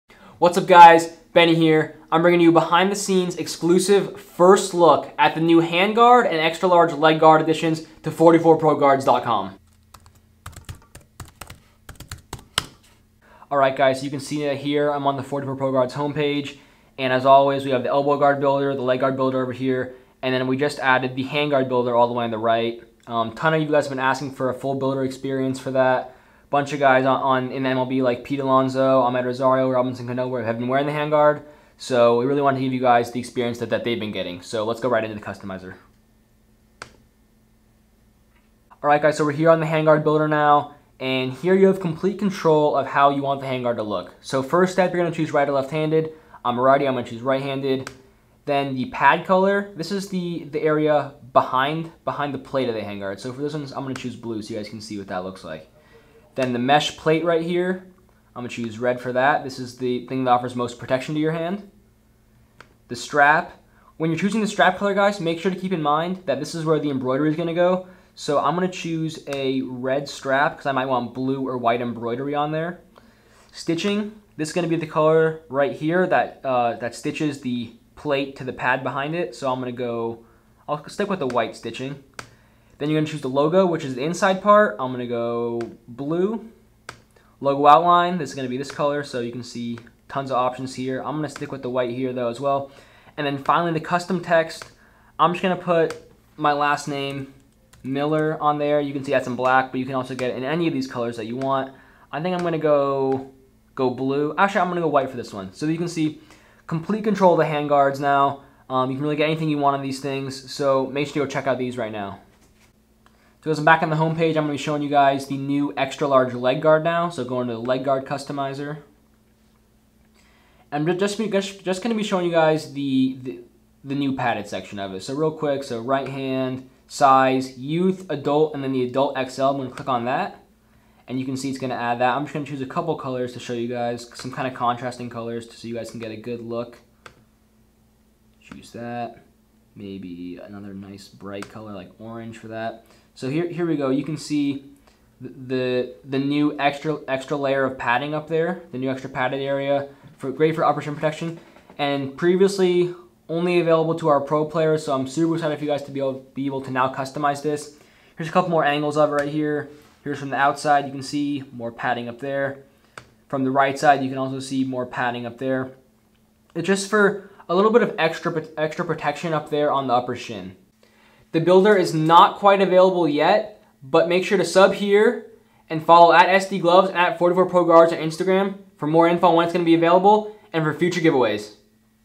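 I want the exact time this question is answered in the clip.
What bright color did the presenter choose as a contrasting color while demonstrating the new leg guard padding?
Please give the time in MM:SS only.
02:21.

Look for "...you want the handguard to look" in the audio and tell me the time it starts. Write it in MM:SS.
00:43.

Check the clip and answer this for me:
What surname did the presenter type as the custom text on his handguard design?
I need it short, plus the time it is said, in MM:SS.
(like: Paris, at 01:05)
Miller, at 01:37.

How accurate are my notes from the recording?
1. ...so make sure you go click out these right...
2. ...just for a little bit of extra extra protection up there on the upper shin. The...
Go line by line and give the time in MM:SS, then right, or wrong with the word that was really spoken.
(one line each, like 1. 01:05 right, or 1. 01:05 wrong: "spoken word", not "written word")
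1. 01:50 wrong: "check", not "click"
2. 02:46 right.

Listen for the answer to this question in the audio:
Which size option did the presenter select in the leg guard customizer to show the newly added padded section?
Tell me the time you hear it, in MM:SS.
02:08.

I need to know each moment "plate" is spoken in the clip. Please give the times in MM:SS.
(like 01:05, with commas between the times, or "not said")
00:52, 00:56, 01:17.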